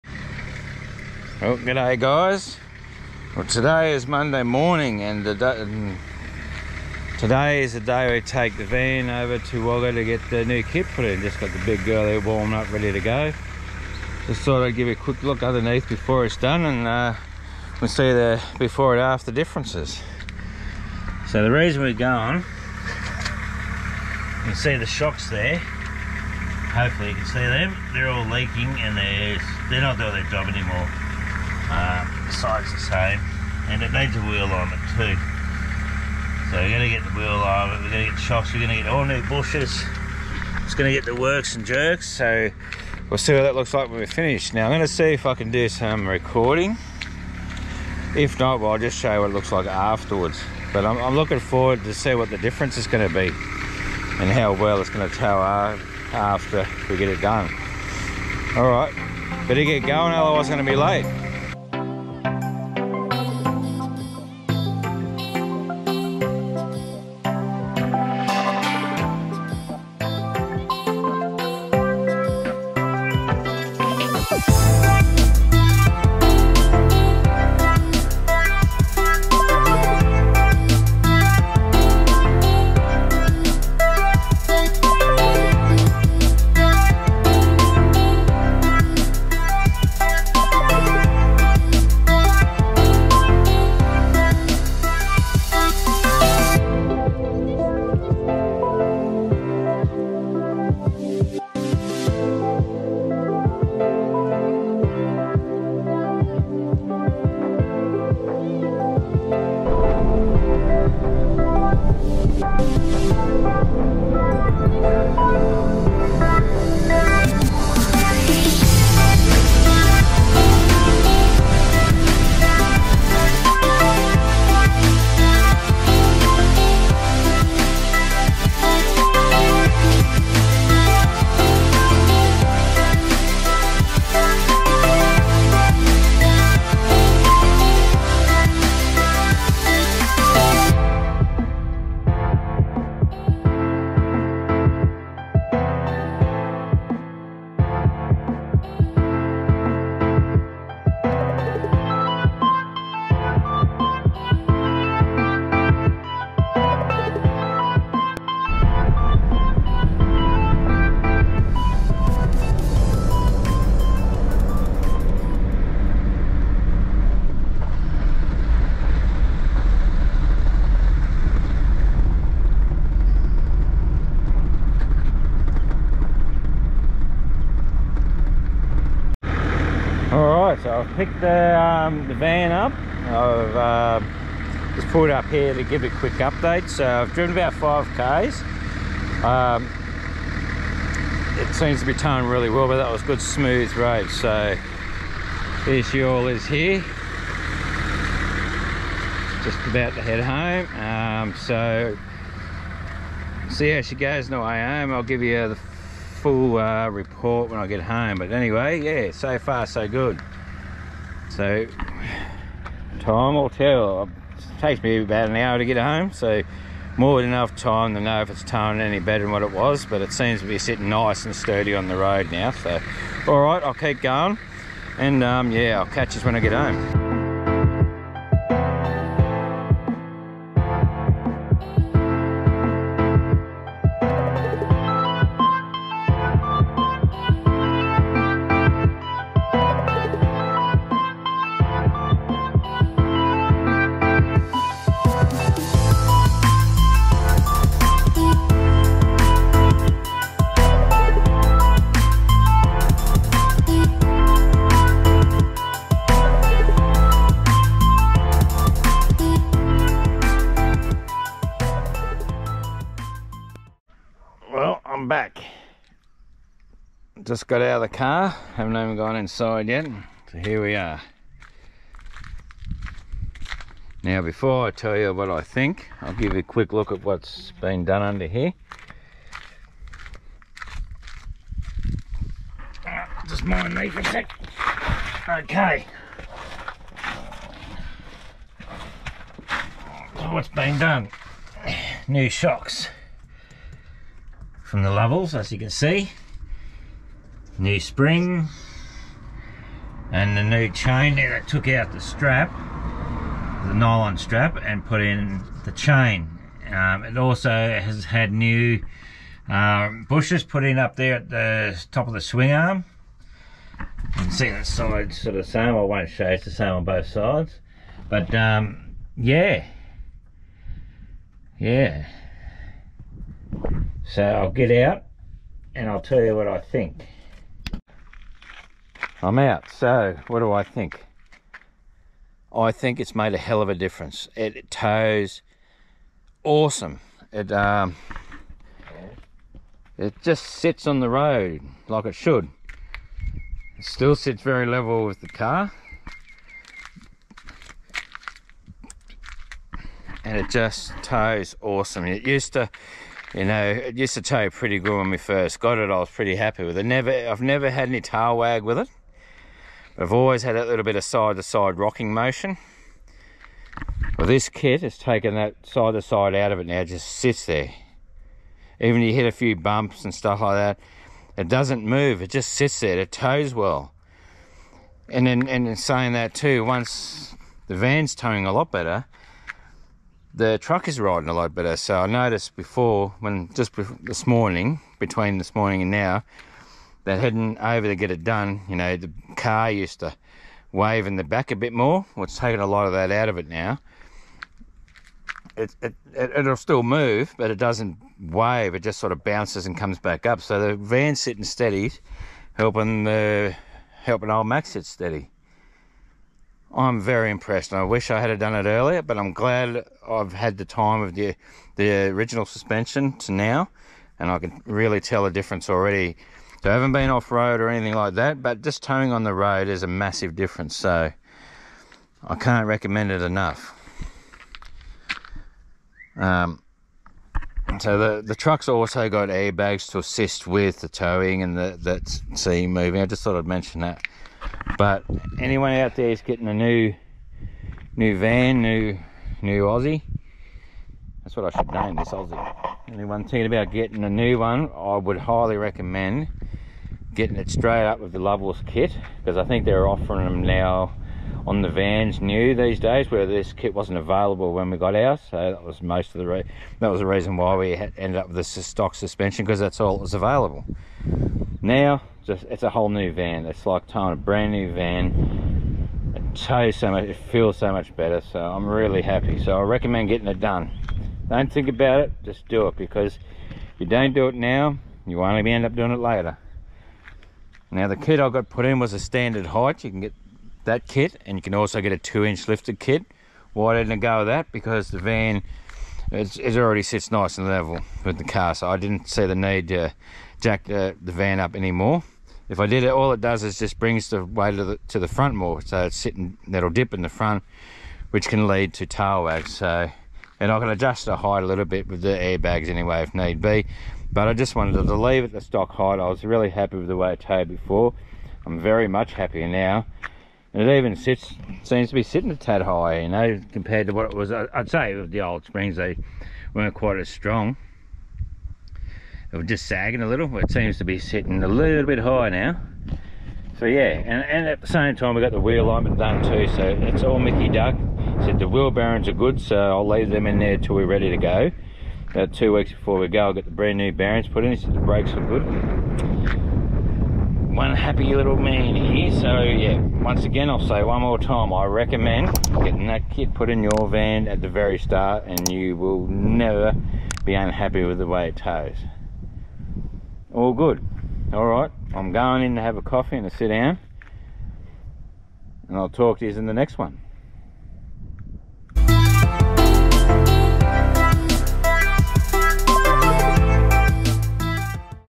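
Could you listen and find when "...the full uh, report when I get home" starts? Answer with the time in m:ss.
3:25.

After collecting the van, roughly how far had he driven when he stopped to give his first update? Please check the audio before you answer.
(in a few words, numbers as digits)
5 km.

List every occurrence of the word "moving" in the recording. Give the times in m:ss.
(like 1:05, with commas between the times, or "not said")
7:12.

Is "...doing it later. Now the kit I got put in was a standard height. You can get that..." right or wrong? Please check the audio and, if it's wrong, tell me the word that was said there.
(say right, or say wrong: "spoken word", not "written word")
right.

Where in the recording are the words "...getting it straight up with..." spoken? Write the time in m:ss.
7:27.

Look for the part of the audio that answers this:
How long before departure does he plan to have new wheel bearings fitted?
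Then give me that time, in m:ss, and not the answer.
8:52.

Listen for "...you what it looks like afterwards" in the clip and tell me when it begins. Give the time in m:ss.
0:49.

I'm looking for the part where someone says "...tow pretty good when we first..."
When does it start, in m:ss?
5:54.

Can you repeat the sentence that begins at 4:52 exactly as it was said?
New shocks from the Lovells, as you can see.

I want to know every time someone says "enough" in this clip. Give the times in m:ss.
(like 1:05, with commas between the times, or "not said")
3:37, 7:03.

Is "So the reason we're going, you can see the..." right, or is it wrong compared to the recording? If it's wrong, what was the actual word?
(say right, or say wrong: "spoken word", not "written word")
right.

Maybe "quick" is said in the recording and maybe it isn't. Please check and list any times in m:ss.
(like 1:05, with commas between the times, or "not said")
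0:14, 3:05, 4:36.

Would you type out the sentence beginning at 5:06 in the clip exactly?
Um, it also has had new um, bushes put in up there at the top of the swing arm.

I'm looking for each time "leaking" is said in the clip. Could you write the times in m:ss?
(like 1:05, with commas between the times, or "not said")
0:28.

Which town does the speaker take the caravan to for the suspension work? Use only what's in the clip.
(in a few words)
Wagga.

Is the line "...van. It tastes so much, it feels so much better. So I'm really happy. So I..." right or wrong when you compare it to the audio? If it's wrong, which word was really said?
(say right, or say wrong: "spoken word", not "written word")
right.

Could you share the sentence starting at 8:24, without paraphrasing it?
But I just wanted to leave it the stock height.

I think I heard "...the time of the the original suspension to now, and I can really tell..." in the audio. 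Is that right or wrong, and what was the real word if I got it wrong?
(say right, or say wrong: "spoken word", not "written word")
right.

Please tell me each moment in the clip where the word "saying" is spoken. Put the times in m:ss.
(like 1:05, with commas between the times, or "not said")
6:15.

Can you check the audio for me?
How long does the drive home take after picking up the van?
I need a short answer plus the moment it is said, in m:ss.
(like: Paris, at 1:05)
about an hour, at 3:35.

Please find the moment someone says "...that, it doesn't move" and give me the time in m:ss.
6:10.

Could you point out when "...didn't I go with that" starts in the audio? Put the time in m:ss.
8:03.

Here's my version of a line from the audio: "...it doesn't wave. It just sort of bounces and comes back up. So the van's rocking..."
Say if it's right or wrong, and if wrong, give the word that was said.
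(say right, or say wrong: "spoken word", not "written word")
wrong: "sitting", not "rocking".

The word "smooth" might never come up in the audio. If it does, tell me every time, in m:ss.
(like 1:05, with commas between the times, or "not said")
3:13.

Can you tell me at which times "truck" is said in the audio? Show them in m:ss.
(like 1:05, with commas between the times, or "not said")
6:20, 7:08.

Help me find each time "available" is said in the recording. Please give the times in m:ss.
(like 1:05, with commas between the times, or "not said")
7:33, 7:40.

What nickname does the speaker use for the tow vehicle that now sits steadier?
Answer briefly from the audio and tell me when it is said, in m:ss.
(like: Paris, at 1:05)
Max, at 6:44.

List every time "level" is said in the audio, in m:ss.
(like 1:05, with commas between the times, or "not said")
5:44, 8:07.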